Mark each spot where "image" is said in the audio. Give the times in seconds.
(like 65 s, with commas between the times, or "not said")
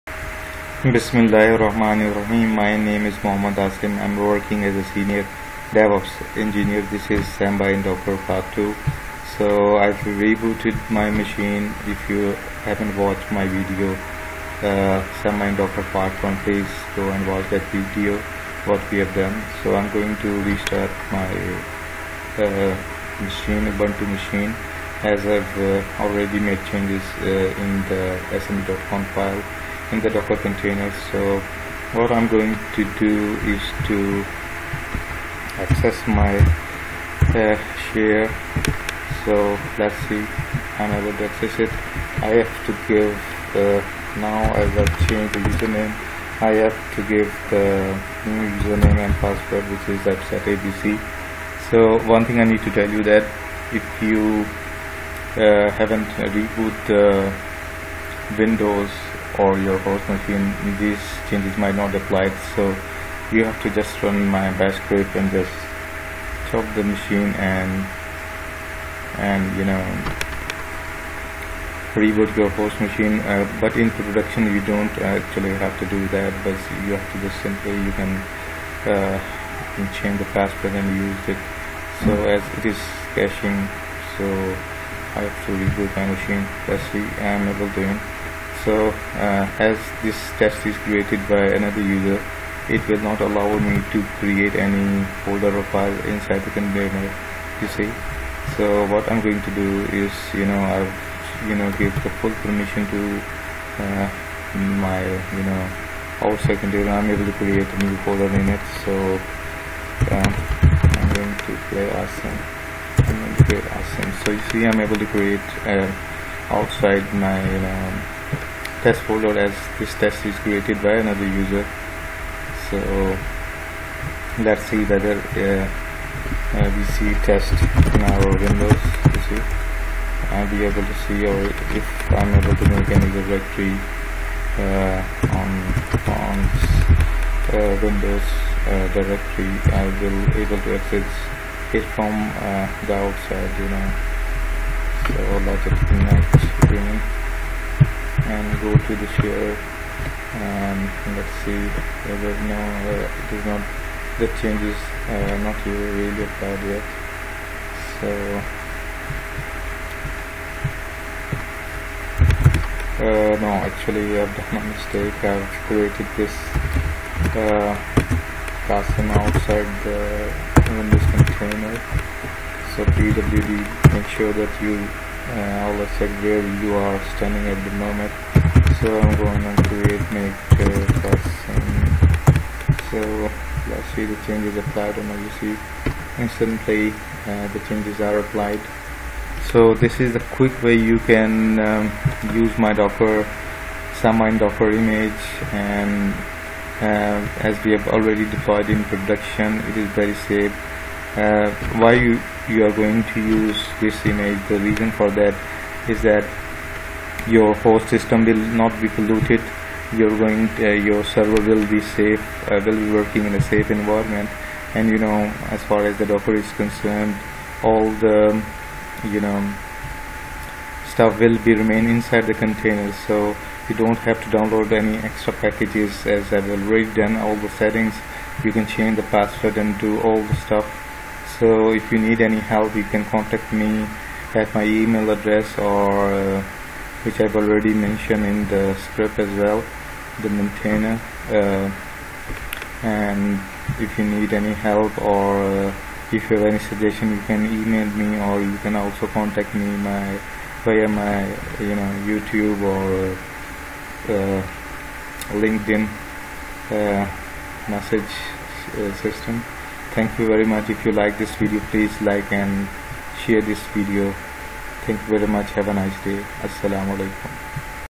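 194 s, 204 s.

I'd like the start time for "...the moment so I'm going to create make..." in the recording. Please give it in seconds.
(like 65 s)
177 s.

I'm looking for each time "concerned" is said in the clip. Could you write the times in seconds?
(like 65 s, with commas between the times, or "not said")
216 s.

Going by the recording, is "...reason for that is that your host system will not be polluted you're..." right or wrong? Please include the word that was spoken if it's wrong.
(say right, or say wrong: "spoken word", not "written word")
right.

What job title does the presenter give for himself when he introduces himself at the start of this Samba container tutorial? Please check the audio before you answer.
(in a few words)
Senior DevOps engineer.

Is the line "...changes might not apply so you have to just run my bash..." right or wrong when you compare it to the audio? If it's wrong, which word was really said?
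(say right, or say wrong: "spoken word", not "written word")
right.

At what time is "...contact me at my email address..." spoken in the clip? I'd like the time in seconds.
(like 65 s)
233 s.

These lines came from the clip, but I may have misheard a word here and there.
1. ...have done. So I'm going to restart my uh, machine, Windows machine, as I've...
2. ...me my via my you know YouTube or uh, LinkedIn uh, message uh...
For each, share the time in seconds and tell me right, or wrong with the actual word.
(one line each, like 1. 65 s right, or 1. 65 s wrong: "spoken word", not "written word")
1. 18 s wrong: "Ubuntu", not "Windows"
2. 249 s right.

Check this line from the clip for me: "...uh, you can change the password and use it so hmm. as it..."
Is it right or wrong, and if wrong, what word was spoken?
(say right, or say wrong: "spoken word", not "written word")
right.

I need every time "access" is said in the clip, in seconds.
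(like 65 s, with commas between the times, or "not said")
35 s, 41 s, 140 s.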